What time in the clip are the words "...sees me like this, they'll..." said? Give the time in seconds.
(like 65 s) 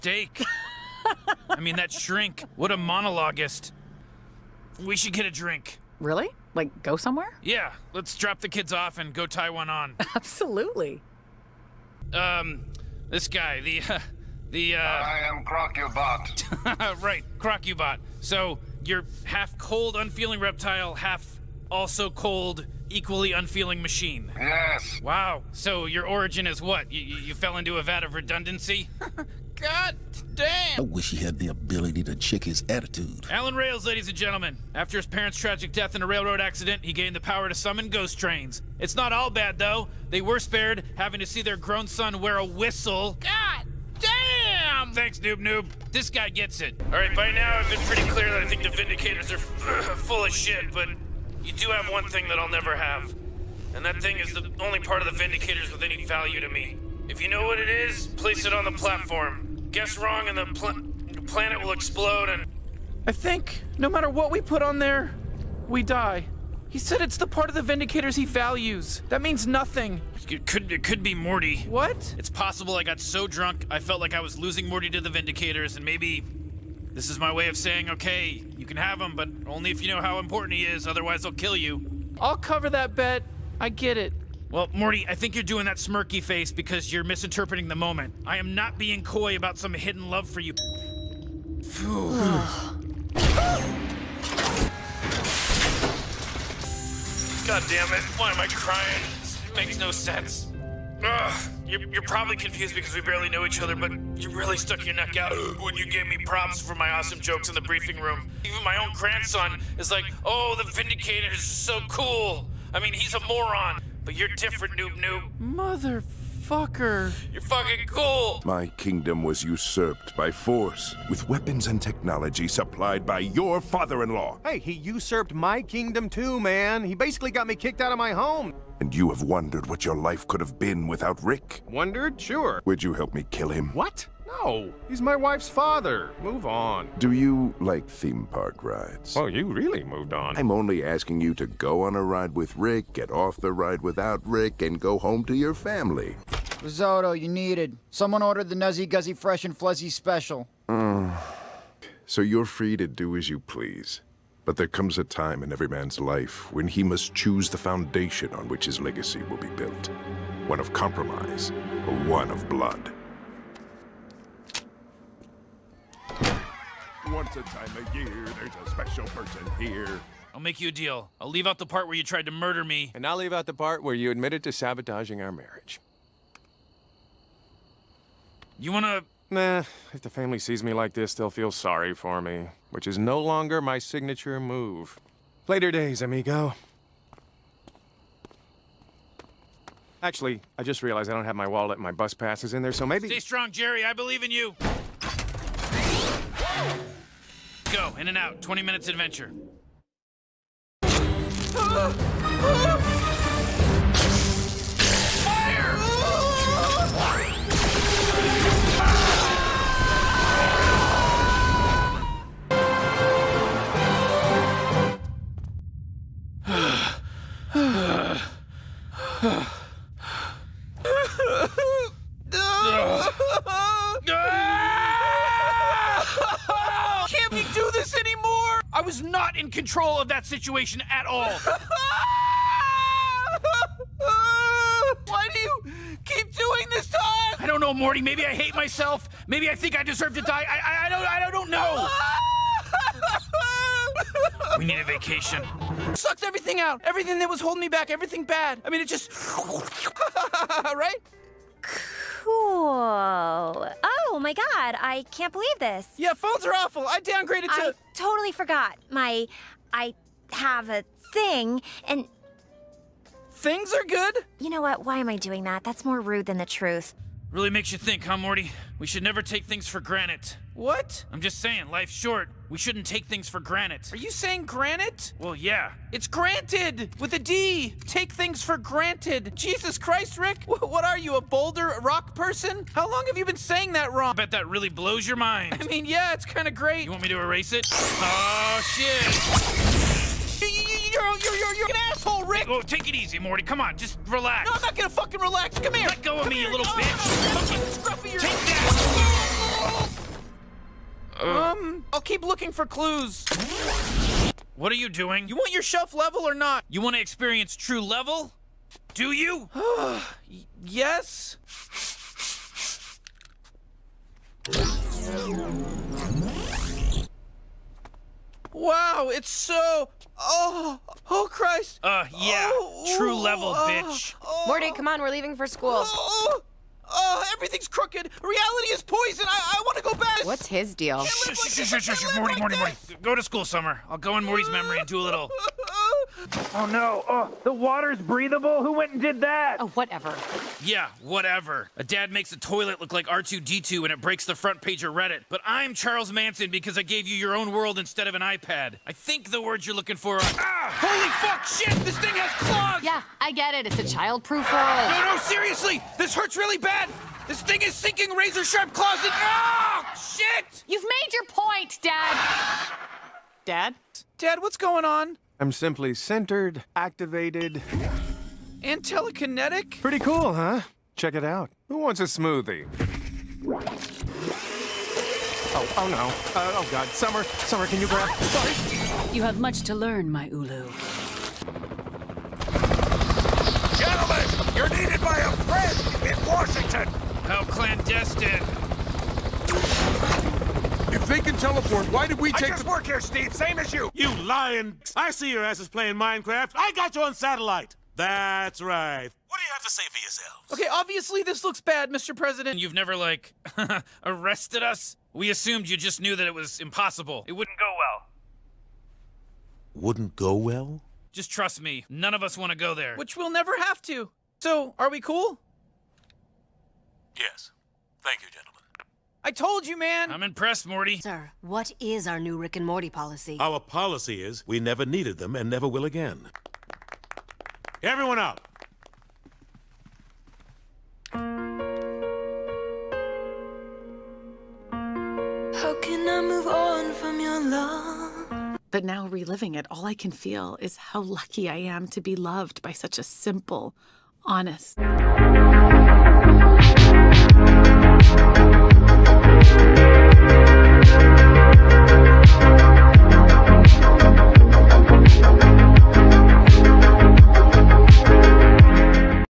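180 s.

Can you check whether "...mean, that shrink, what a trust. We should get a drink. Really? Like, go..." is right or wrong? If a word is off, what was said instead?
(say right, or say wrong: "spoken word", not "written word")
wrong: "monologuist", not "trust".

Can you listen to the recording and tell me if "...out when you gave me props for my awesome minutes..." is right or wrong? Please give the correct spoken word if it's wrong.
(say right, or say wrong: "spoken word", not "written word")
wrong: "jokes", not "minutes".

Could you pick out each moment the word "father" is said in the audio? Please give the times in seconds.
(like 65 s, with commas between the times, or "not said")
123 s, 135 s.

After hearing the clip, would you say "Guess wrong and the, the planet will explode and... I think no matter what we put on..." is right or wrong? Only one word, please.
right.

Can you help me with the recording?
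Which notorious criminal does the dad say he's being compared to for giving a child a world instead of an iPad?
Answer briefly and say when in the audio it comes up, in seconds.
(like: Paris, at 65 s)
Charles Manson, at 345 s.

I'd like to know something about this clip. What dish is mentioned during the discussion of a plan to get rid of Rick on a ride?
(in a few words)
Risotto.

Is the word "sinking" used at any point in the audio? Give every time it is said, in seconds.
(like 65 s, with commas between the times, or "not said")
357 s.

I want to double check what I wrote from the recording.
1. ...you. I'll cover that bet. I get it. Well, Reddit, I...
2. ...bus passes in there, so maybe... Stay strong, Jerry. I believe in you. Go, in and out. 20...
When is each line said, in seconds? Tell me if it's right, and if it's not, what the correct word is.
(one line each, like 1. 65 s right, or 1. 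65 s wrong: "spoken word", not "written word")
1. 81 s wrong: "Morty", not "Reddit"
2. 191 s right.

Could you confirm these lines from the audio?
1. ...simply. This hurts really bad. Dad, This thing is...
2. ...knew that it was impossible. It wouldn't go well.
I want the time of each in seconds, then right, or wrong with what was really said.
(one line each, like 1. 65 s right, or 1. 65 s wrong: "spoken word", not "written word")
1. 355 s wrong: "seriously", not "simply"
2. 406 s right.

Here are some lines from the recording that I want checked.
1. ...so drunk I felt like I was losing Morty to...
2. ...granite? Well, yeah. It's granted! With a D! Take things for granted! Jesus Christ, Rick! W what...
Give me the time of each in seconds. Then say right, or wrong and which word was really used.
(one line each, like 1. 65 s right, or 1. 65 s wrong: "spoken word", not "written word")
1. 72 s right
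2. 274 s right.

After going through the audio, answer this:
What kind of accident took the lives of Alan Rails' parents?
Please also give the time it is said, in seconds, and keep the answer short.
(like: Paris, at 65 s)
Railroad accident, at 36 s.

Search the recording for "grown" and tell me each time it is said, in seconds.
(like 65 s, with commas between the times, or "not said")
41 s.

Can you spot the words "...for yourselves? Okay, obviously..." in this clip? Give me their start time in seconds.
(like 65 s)
399 s.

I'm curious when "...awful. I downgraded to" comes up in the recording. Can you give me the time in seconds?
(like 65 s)
256 s.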